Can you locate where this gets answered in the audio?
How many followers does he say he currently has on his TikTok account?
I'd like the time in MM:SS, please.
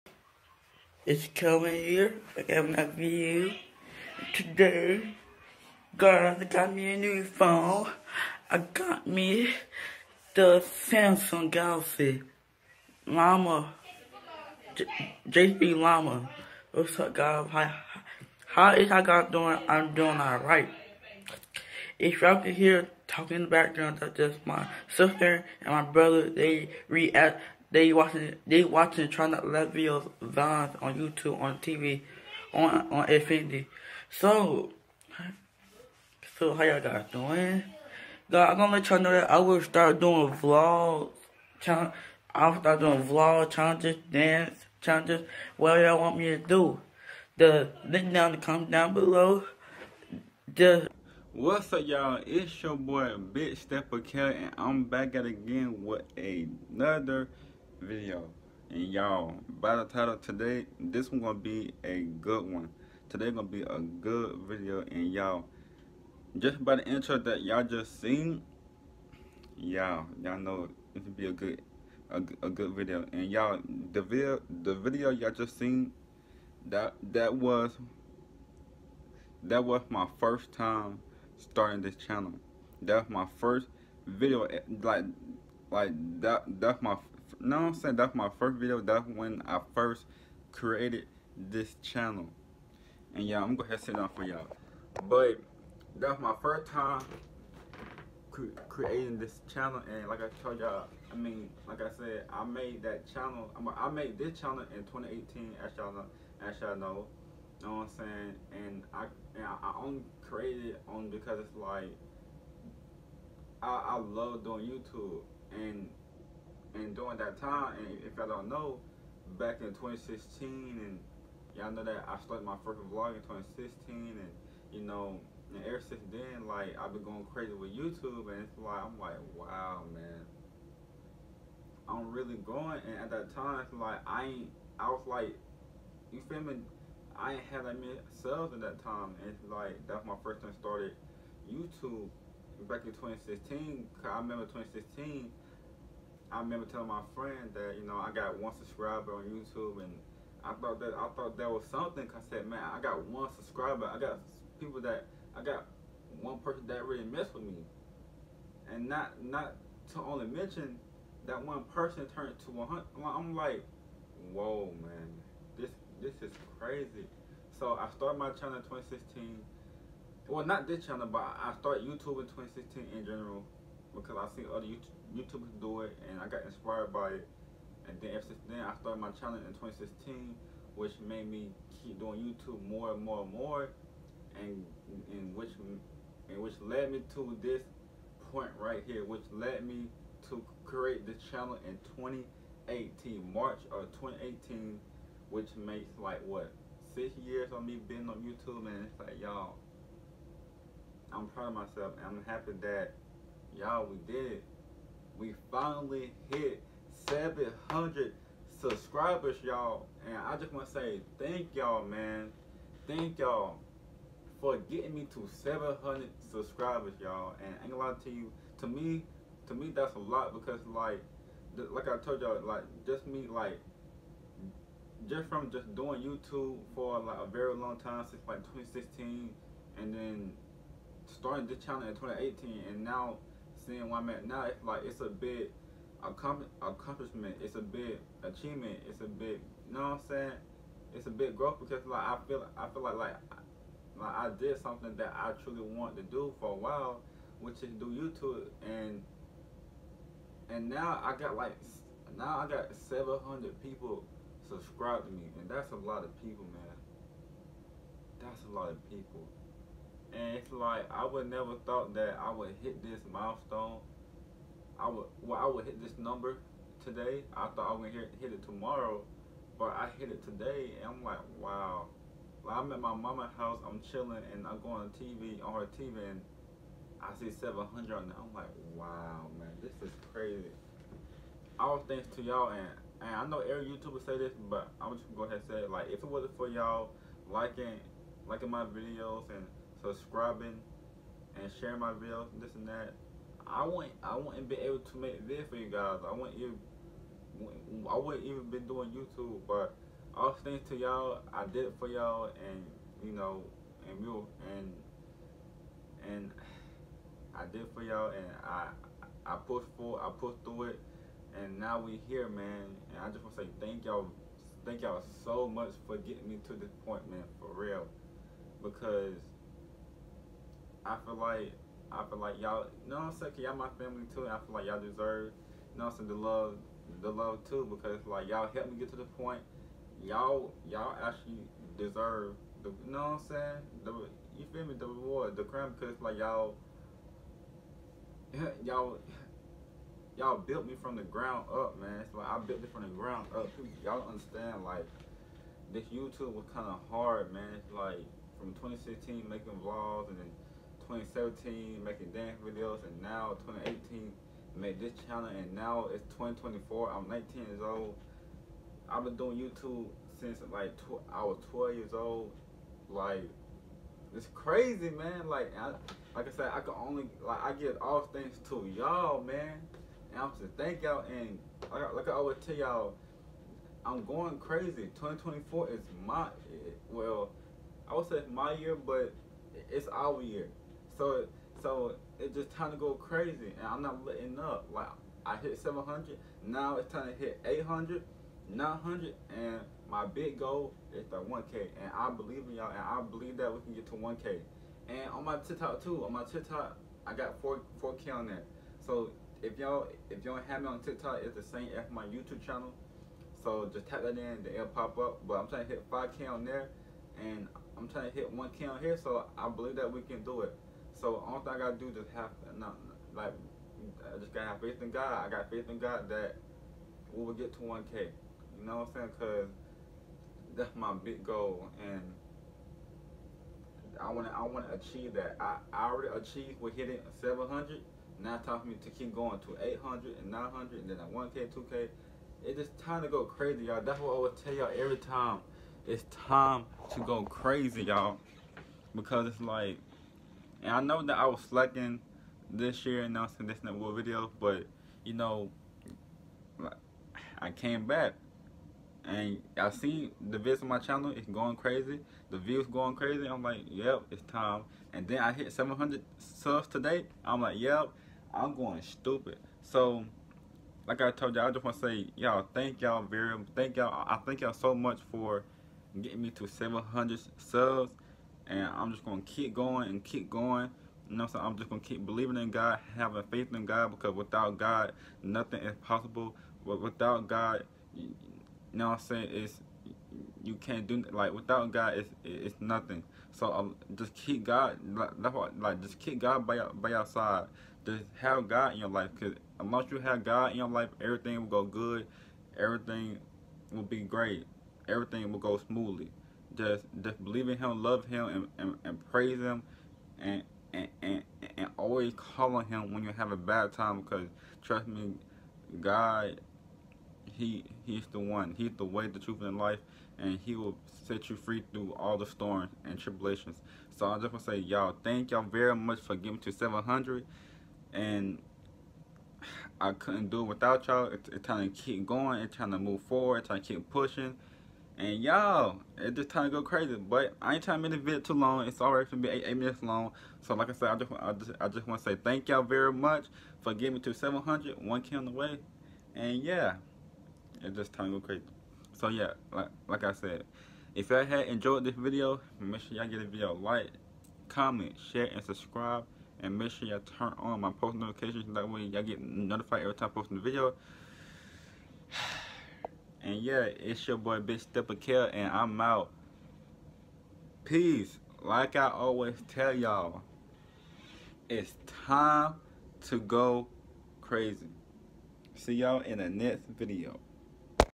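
06:37.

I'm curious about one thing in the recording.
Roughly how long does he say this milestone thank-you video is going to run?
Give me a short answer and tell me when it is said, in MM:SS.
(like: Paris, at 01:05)
8 minutes, at 08:49.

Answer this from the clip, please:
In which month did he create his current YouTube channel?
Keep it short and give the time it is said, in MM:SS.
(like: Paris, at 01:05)
March, at 03:13.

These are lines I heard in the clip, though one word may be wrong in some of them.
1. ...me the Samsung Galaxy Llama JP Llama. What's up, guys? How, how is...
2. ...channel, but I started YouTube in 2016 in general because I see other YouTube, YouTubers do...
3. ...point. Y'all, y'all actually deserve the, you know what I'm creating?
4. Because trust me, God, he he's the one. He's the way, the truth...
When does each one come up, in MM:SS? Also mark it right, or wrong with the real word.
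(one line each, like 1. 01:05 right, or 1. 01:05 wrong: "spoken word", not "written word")
1. 00:09 right
2. 02:50 right
3. 05:29 wrong: "saying", not "creating"
4. 08:24 right.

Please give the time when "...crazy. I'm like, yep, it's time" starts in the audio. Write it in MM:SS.
07:32.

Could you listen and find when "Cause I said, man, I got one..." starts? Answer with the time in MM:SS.
02:32.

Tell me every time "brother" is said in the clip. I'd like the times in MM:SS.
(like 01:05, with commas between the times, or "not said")
00:25.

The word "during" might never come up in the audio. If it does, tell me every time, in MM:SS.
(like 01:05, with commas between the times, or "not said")
01:56.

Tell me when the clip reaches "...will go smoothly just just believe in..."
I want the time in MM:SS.
08:15.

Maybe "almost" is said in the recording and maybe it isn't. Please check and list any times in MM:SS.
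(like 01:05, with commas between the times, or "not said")
not said.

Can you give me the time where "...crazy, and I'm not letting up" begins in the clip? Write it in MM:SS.
06:22.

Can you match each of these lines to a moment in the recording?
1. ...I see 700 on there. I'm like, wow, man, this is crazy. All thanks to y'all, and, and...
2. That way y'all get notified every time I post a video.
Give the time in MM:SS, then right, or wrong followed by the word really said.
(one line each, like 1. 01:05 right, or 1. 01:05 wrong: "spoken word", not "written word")
1. 04:37 right
2. 09:08 right.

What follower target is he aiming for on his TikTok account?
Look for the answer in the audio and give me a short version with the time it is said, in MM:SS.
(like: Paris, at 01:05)
5K, at 06:45.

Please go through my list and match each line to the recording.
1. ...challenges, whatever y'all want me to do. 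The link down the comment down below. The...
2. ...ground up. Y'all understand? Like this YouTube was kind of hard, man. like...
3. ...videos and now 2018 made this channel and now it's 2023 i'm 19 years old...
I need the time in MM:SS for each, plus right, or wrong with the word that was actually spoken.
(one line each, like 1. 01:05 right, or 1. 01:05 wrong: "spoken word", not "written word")
1. 00:44 right
2. 05:42 right
3. 05:52 wrong: "2024", not "2023".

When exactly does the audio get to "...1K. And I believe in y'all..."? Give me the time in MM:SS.
06:31.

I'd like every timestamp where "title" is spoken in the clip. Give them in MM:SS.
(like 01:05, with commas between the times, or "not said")
00:59.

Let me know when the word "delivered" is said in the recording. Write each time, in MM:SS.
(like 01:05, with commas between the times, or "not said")
not said.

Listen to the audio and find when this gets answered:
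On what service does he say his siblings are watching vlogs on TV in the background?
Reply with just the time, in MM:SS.
00:33.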